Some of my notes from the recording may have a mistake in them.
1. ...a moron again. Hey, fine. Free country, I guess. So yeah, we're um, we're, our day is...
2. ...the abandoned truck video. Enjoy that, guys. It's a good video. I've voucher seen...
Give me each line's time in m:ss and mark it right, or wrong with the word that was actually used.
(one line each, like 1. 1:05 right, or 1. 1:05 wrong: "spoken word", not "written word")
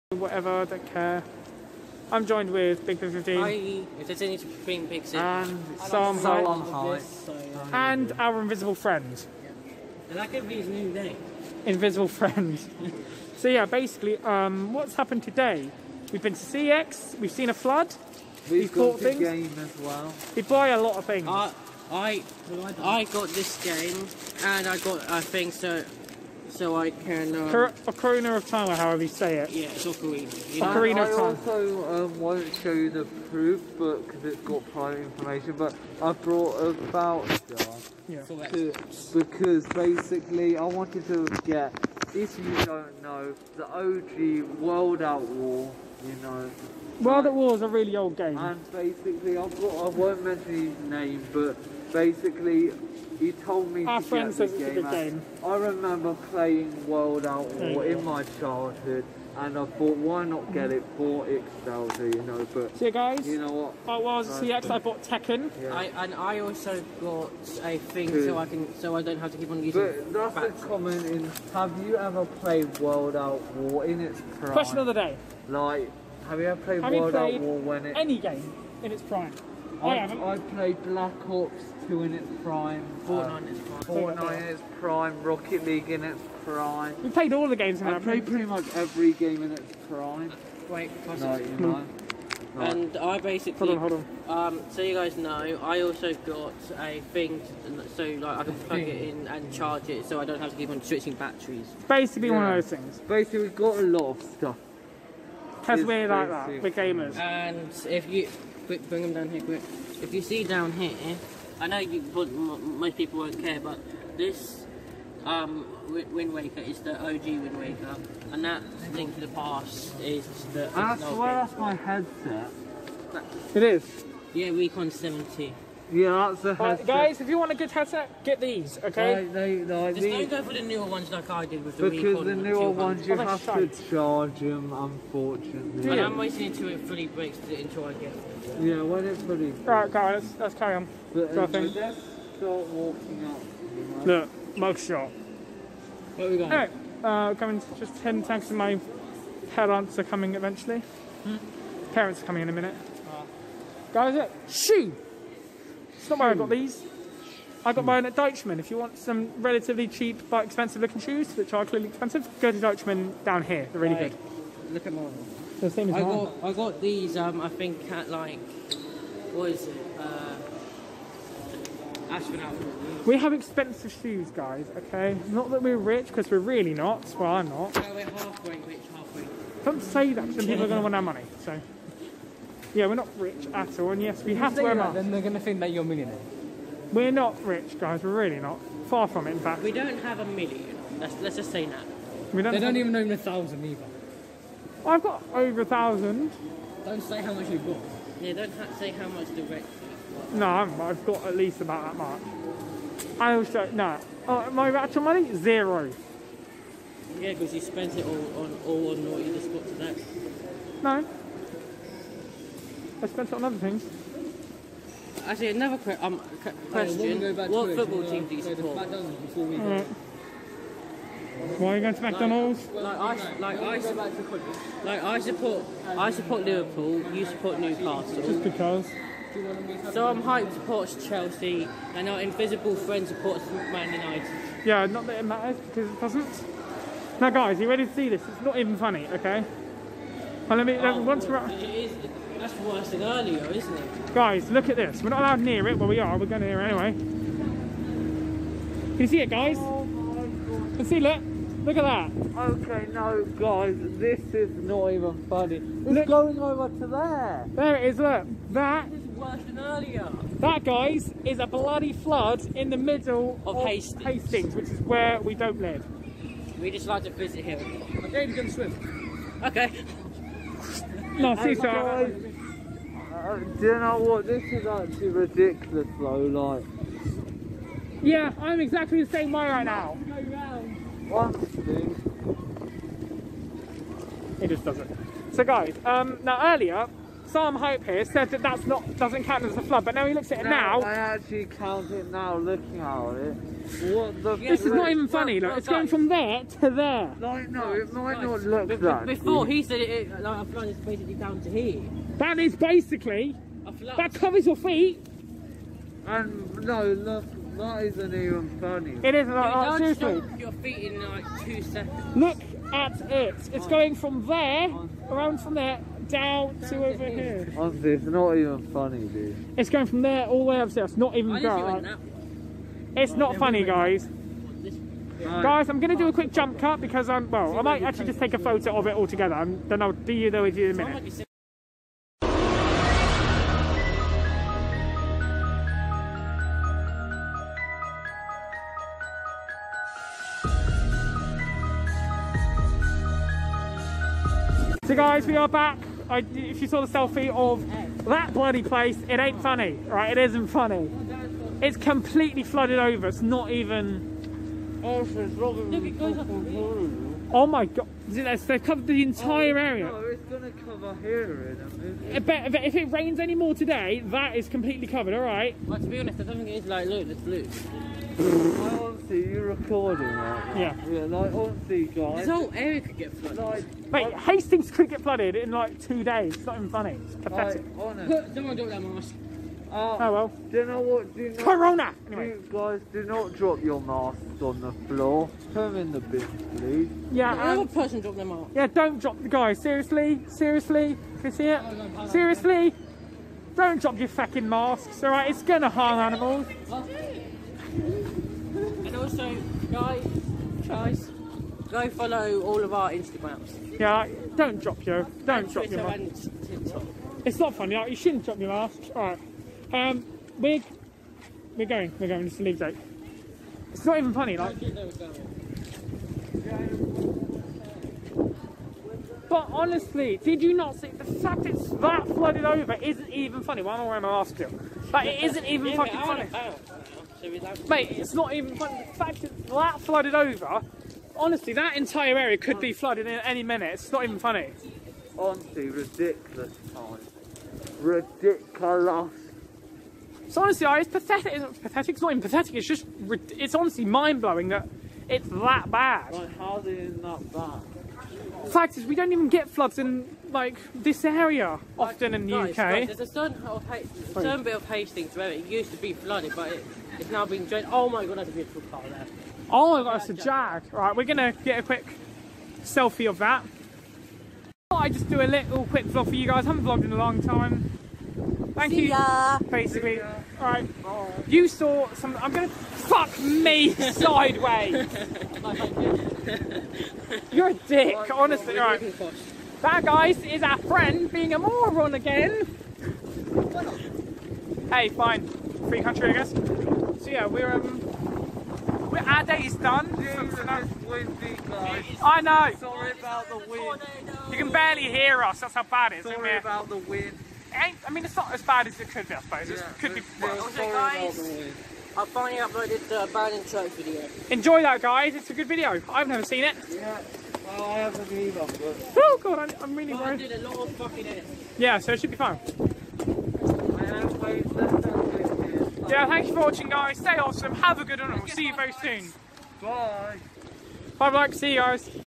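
1. 8:01 right
2. 8:22 wrong: "never", not "voucher".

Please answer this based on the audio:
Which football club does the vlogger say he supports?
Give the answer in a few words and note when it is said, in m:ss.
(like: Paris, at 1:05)
Liverpool, at 3:46.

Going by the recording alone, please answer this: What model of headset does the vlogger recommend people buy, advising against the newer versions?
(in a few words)
Recon 70.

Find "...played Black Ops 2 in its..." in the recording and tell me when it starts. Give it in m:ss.
1:20.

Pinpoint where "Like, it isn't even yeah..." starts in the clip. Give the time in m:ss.
7:04.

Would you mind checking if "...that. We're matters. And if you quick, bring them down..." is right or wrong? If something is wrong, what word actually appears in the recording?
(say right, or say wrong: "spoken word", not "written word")
wrong: "gamers", not "matters".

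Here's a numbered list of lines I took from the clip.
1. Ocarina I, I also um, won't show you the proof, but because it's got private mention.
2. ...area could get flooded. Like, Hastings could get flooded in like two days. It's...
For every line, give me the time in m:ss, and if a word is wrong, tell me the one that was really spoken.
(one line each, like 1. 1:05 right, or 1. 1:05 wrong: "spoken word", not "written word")
1. 0:30 wrong: "information", not "mention"
2. 6:12 right.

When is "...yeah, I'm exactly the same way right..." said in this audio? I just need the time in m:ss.
4:38.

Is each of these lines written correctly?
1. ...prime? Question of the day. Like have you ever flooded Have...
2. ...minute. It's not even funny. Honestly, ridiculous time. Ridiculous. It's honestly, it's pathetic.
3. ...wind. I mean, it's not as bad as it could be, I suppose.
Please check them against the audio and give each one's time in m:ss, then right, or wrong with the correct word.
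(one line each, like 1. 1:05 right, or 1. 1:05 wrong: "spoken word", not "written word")
1. 1:14 wrong: "played", not "flooded"
2. 7:13 right
3. 8:16 right.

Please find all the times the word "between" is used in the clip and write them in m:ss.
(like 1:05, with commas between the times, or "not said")
0:04.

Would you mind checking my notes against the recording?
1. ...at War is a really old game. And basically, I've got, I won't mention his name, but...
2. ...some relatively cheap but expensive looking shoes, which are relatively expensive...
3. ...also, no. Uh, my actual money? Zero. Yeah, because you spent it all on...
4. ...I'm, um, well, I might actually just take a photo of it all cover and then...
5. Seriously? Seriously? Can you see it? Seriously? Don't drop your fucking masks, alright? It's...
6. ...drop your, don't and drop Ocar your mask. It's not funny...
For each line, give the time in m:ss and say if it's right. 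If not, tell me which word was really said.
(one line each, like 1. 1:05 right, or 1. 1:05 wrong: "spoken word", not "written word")
1. 0:47 right
2. 2:38 wrong: "clearly", not "relatively"
3. 3:23 right
4. 5:27 wrong: "together", not "cover"
5. 6:29 right
6. 6:44 wrong: "Twitter", not "Ocar".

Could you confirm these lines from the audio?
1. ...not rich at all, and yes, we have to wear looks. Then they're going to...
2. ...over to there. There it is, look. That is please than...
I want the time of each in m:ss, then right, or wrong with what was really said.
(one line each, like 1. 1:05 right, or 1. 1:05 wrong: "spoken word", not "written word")
1. 3:02 wrong: "masks", not "looks"
2. 4:16 wrong: "worse", not "please".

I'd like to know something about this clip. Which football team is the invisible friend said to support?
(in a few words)
Man United.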